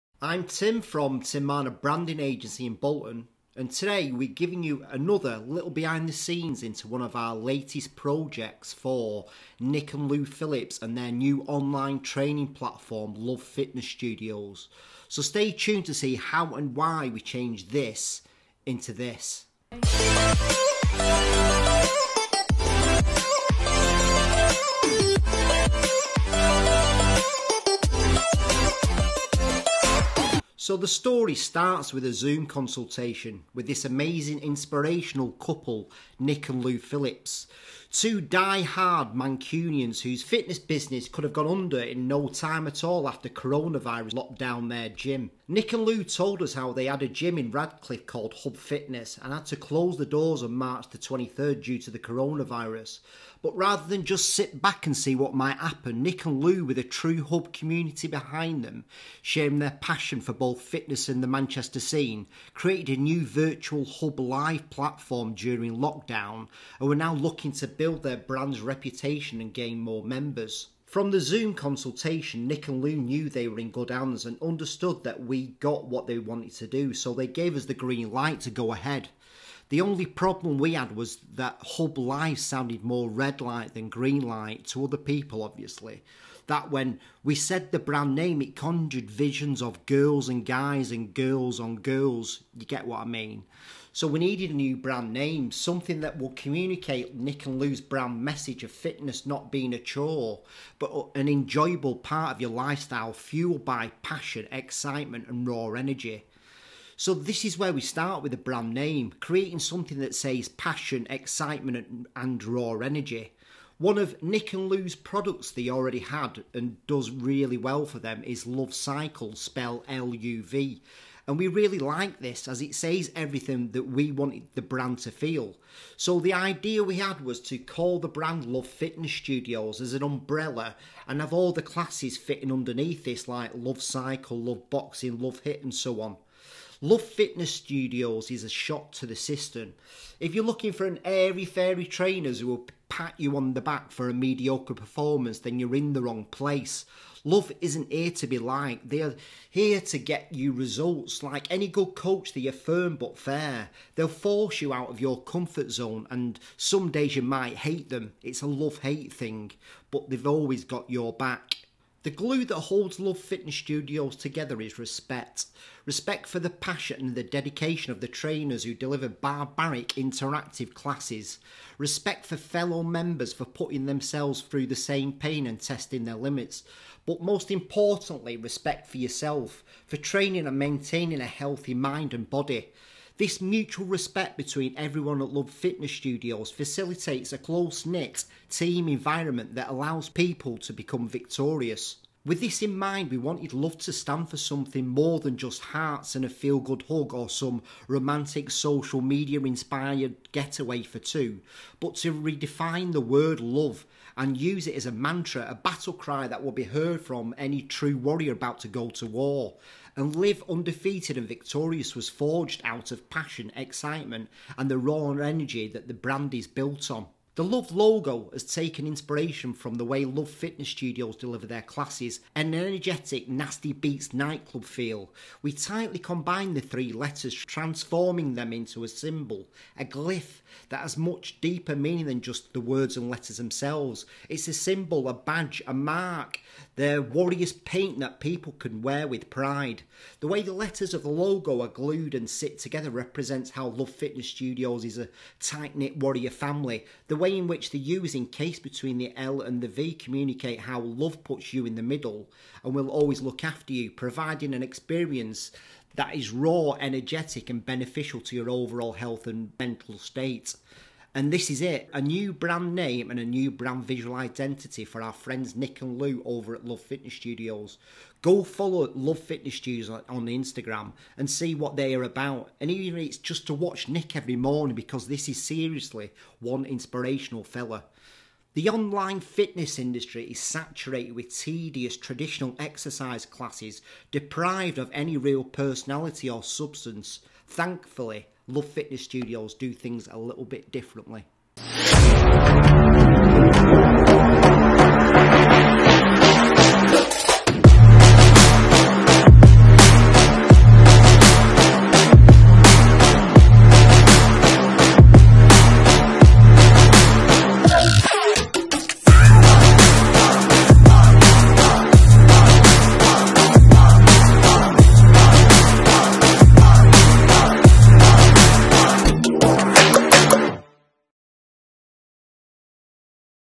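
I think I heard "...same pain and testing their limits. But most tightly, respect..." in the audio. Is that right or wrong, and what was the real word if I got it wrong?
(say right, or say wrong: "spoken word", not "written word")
wrong: "importantly", not "tightly".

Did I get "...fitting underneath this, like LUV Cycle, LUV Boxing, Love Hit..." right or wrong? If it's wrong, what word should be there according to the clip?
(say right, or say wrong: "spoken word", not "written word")
right.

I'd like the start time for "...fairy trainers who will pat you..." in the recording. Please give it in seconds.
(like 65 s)
141 s.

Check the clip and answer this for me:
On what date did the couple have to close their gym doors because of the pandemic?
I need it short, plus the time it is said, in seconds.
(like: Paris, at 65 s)
March 23rd, at 50 s.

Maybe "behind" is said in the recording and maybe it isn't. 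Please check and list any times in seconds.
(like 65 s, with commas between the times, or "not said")
5 s, 58 s.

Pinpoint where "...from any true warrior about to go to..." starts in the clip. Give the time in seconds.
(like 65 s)
207 s.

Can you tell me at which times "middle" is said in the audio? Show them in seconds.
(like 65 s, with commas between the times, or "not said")
251 s.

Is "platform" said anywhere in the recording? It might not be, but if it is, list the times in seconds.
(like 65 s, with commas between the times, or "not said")
12 s, 64 s.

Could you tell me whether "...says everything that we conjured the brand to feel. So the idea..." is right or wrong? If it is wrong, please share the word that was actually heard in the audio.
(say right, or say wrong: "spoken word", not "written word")
wrong: "wanted", not "conjured".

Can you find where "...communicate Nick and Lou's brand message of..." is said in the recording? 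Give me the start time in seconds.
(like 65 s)
96 s.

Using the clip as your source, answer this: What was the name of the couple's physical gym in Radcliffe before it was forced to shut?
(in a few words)
Hub Fitness.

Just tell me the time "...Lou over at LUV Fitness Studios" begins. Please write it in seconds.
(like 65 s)
266 s.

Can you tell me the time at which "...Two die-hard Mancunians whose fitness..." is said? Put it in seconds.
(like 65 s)
37 s.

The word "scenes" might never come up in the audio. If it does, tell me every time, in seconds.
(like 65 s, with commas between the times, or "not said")
6 s, 61 s.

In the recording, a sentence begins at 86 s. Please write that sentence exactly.
That when we said the brand name, it conjured visions of girls and guys and girls on girls.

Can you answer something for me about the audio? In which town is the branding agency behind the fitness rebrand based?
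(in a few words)
Bolton.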